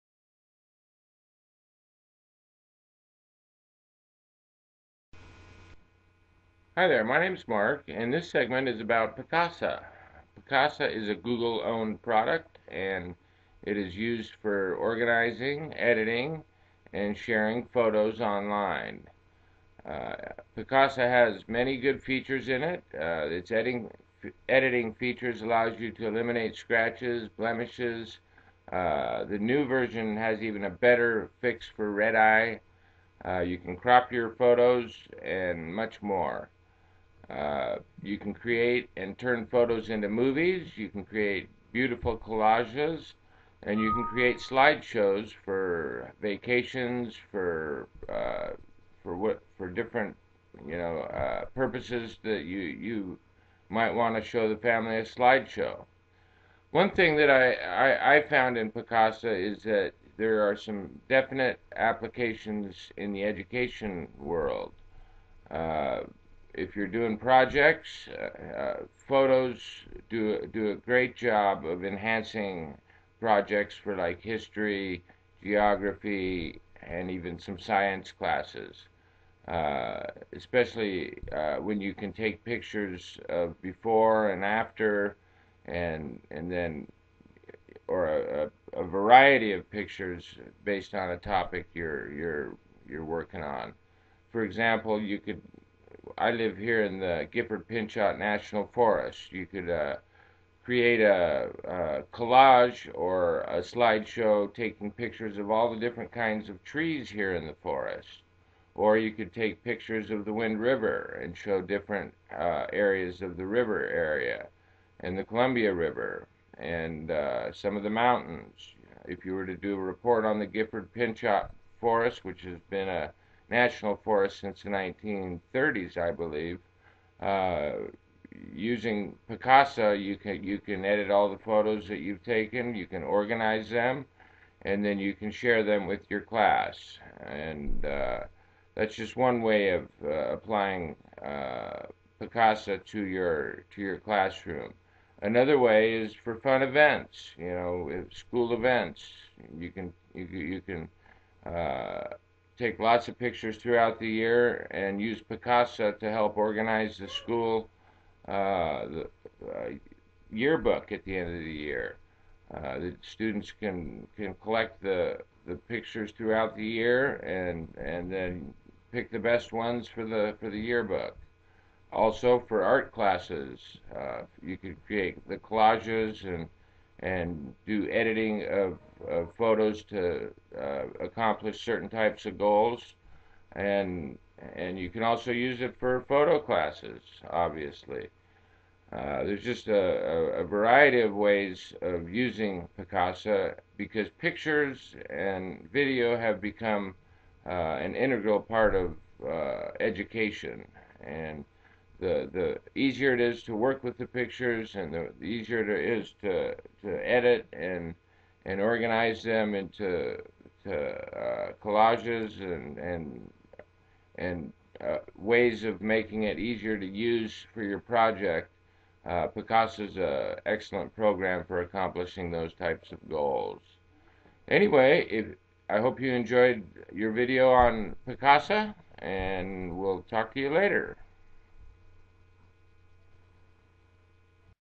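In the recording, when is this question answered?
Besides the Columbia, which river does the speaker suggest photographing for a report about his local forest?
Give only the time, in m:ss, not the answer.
1:50.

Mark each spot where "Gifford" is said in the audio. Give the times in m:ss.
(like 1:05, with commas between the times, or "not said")
1:37, 2:00.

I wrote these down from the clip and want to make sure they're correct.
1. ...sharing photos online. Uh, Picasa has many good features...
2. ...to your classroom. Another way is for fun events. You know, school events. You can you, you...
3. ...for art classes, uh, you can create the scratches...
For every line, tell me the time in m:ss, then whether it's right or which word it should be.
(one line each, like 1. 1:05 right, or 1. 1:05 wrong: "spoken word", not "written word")
1. 0:17 right
2. 2:23 right
3. 2:52 wrong: "collages", not "scratches".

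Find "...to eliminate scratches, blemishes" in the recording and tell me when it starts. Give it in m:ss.
0:25.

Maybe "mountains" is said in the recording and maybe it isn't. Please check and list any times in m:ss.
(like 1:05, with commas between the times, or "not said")
1:57.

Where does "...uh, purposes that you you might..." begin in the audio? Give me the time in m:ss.
0:51.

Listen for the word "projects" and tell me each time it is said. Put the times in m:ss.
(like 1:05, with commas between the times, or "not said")
1:07, 1:13, 3:37.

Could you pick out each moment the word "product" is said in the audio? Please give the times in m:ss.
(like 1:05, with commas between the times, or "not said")
0:12.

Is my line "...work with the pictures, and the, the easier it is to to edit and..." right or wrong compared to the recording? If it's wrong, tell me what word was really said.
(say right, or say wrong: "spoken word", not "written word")
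right.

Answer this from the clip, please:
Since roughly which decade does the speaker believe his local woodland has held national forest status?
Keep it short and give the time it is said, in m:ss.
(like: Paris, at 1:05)
1930s, at 2:04.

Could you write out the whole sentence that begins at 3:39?
Uh, Picasa is an excellent program for accomplishing those types of goals.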